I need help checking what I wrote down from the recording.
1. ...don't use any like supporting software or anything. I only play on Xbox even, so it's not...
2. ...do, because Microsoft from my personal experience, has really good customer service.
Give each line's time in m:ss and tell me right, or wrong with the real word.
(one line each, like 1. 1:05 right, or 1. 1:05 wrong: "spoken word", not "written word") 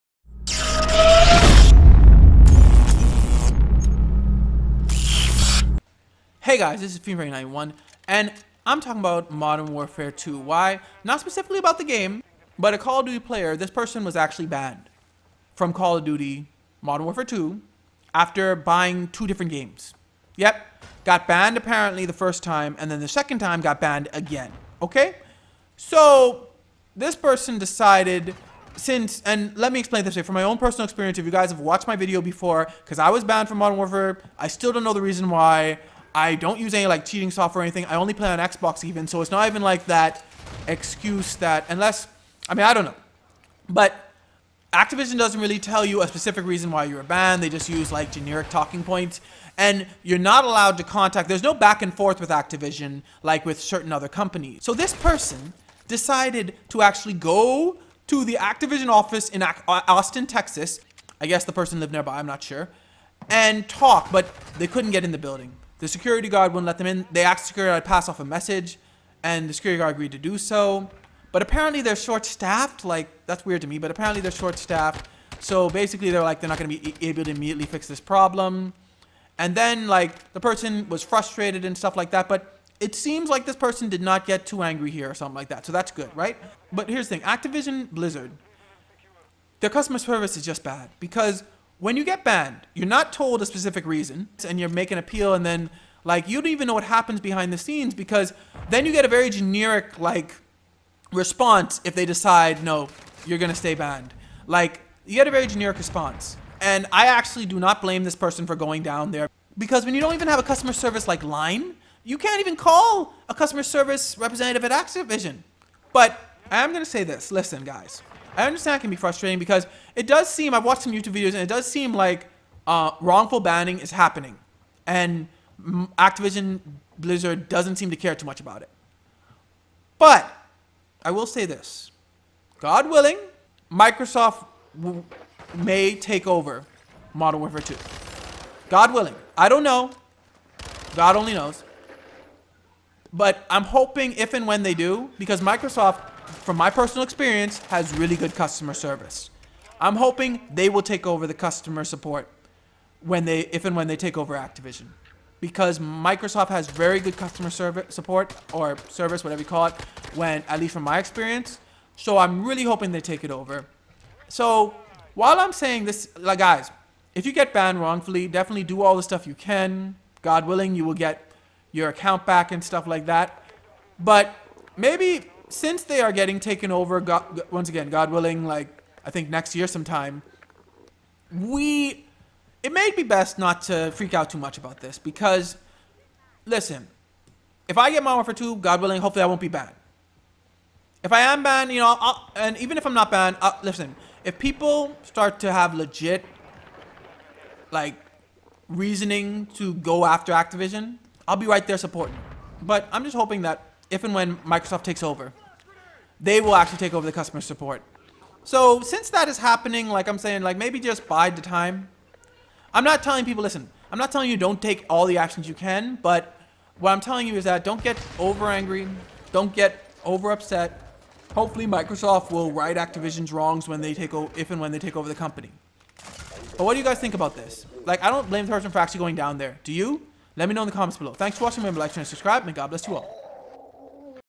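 1. 0:36 wrong: "cheating", not "supporting"
2. 2:24 right.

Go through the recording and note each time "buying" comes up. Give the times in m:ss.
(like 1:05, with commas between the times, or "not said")
0:18.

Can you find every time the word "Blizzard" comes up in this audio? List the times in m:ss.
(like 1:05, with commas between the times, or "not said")
1:27, 2:06.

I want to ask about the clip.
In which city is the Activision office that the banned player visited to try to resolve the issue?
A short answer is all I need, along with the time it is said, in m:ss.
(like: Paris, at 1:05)
Austin, Texas, at 0:59.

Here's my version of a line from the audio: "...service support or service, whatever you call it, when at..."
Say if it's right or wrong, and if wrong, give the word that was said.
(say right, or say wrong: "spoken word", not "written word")
right.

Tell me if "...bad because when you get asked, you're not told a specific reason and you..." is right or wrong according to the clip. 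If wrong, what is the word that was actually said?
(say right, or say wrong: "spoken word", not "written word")
wrong: "banned", not "asked".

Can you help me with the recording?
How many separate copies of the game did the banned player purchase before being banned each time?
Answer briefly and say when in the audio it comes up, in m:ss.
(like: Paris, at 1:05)
2, at 0:19.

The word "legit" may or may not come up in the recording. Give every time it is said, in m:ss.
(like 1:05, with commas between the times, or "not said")
3:15.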